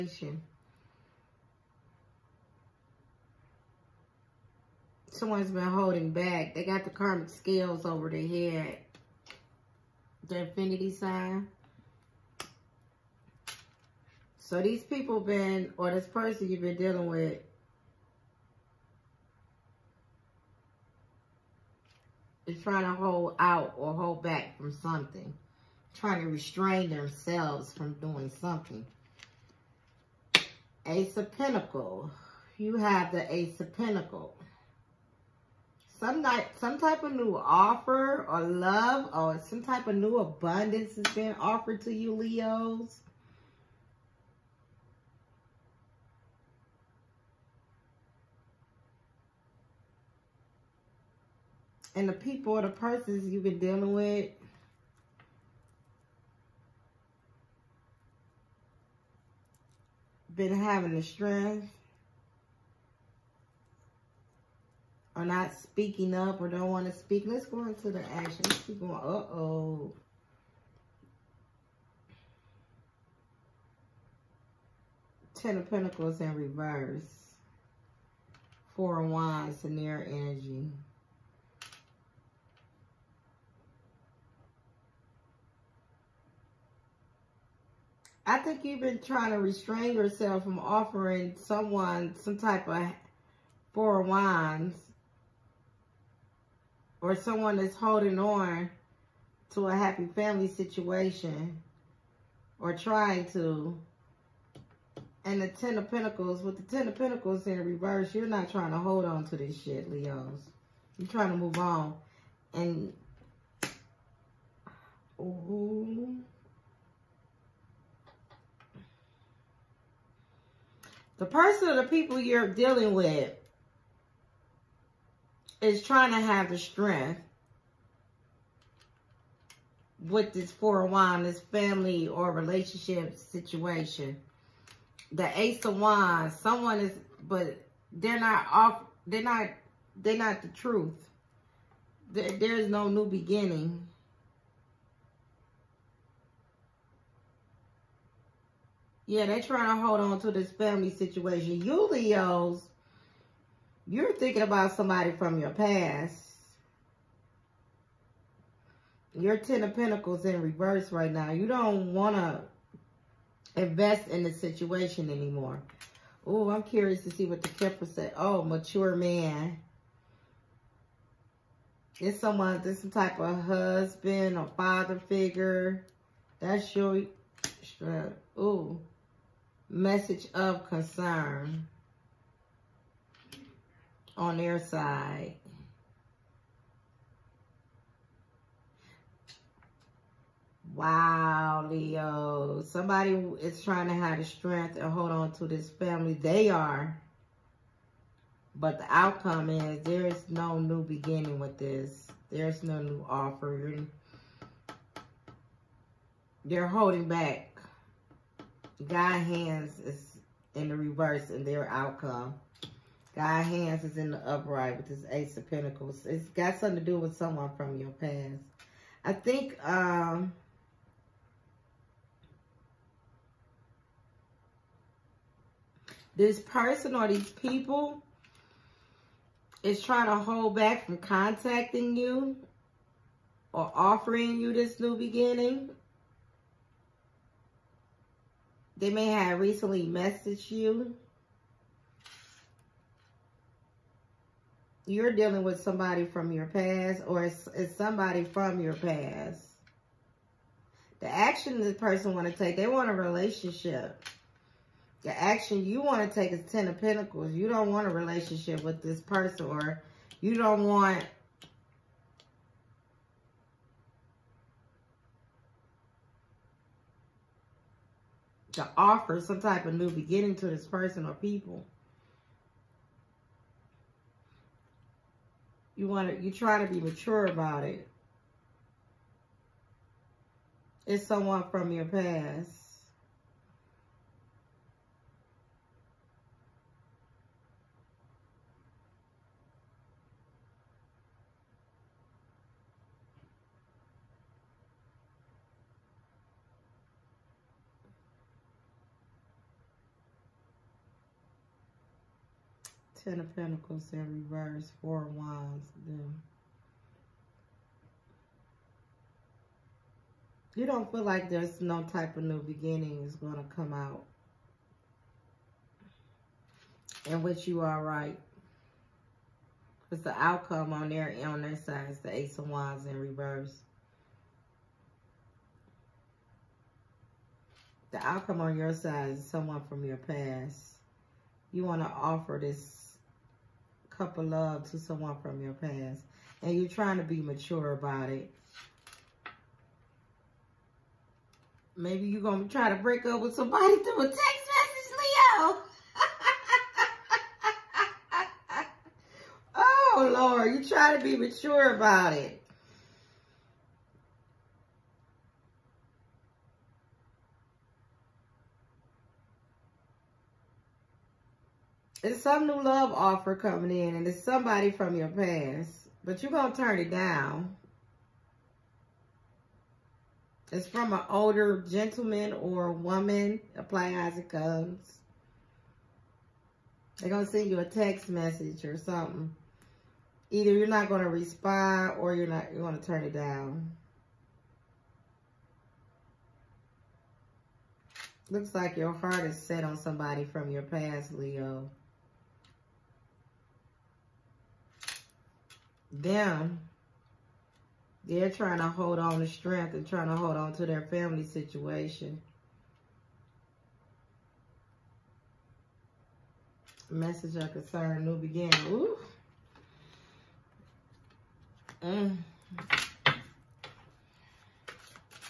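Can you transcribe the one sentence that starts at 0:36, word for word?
Some, night, some type of new offer or love or some type of new abundance is being offered to you, Leos.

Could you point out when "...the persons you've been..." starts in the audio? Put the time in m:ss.
0:52.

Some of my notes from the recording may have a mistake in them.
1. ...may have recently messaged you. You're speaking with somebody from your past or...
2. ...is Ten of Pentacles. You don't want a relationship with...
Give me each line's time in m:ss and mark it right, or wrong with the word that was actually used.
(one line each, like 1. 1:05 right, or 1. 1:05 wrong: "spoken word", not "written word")
1. 3:58 wrong: "dealing", not "speaking"
2. 4:16 right.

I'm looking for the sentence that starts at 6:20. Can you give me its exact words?
Either you're not going to respond or you're not you're going to turn it down.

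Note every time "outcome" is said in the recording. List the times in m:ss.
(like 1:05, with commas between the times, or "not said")
3:18, 3:31, 5:20, 5:28.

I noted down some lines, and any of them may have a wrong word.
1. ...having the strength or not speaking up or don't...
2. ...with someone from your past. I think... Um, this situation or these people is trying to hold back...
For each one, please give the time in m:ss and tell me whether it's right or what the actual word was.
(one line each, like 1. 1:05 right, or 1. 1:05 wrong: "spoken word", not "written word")
1. 1:00 right
2. 3:36 wrong: "person", not "situation".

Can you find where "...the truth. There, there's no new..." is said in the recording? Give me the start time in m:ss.
2:20.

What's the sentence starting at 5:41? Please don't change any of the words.
Maybe you're going to try to break up with somebody through a text message, Leo.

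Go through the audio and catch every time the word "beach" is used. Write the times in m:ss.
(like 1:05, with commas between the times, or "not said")
not said.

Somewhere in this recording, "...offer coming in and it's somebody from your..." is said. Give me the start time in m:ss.
6:02.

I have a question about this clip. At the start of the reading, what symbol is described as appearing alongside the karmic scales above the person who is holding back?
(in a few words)
Infinity sign.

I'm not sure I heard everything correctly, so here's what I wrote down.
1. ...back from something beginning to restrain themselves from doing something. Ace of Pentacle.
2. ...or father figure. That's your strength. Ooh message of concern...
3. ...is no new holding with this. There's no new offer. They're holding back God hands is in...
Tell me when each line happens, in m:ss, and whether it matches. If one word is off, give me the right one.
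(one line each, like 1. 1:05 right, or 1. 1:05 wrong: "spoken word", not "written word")
1. 0:24 wrong: "trying", not "beginning"
2. 2:54 right
3. 3:20 wrong: "beginning", not "holding".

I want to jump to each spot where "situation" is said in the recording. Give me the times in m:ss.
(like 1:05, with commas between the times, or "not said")
1:40, 2:13, 2:30, 2:44, 6:41.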